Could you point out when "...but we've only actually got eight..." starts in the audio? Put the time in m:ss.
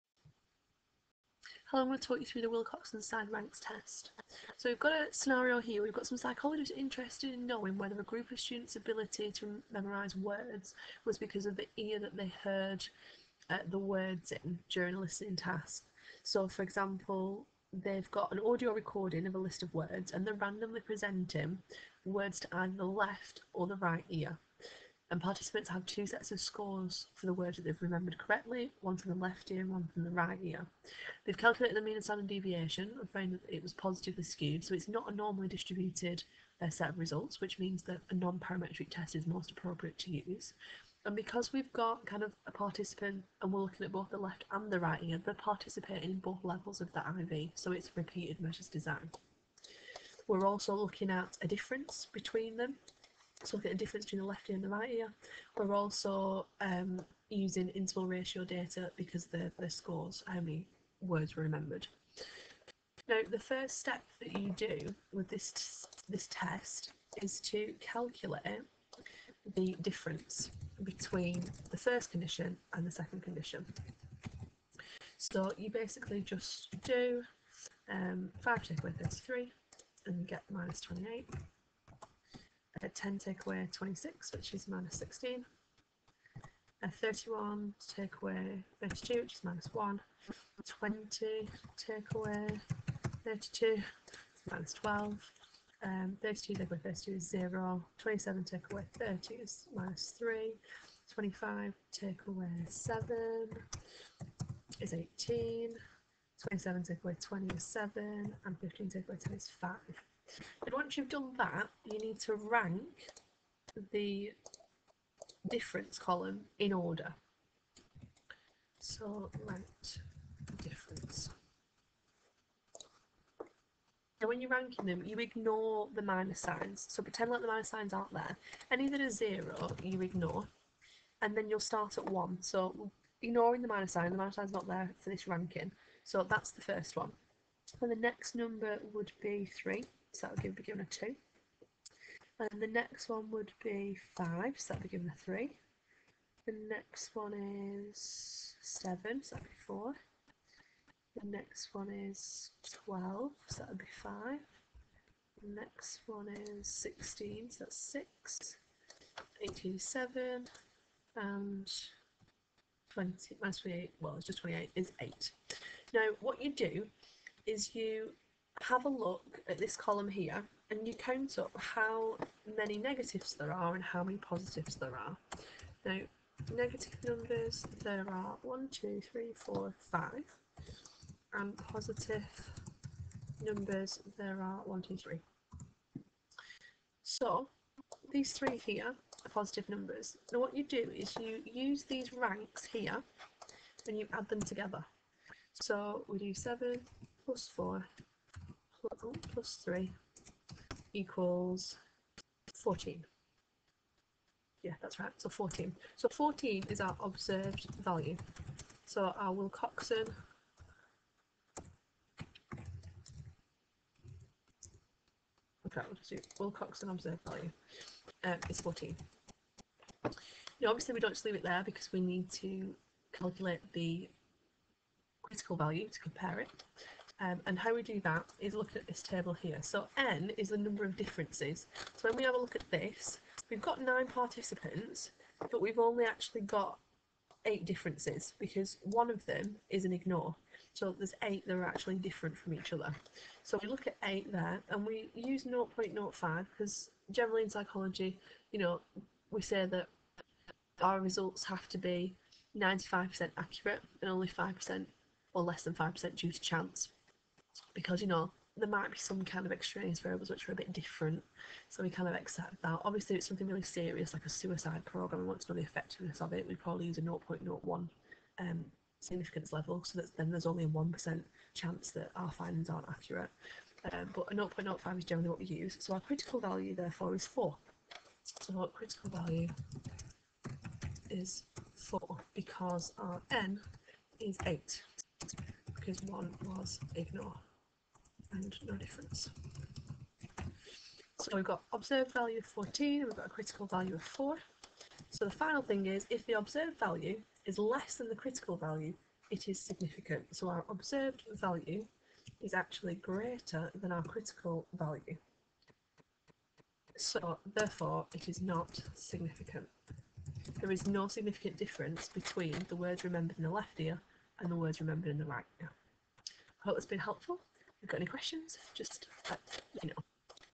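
3:55.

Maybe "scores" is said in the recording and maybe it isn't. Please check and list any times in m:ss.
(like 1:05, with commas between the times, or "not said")
0:26, 0:59.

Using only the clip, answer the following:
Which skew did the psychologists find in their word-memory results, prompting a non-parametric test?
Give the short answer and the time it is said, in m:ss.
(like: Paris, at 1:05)
Positively skewed, at 0:33.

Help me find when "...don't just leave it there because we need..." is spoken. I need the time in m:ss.
3:40.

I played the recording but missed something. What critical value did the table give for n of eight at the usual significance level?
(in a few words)
4.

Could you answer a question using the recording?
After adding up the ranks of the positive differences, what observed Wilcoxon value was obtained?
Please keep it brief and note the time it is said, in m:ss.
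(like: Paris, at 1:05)
14, at 3:26.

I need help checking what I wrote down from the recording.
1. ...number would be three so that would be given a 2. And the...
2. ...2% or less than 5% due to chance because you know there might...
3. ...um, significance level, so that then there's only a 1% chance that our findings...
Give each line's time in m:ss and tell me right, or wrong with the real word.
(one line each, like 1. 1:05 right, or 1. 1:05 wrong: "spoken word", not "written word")
1. 2:18 right
2. 4:14 wrong: "5", not "2"
3. 4:28 right.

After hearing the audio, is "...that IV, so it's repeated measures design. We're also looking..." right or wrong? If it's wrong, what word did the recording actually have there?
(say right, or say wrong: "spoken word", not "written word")
right.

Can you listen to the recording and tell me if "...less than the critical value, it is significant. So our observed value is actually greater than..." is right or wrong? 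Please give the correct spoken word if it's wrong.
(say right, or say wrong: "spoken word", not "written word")
right.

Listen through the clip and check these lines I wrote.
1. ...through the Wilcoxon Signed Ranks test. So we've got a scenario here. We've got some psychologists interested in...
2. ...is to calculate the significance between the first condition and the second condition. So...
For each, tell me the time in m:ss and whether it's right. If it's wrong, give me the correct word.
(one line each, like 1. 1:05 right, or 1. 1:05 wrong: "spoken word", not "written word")
1. 0:02 right
2. 1:07 wrong: "difference", not "significance".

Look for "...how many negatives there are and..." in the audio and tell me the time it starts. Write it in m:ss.
2:51.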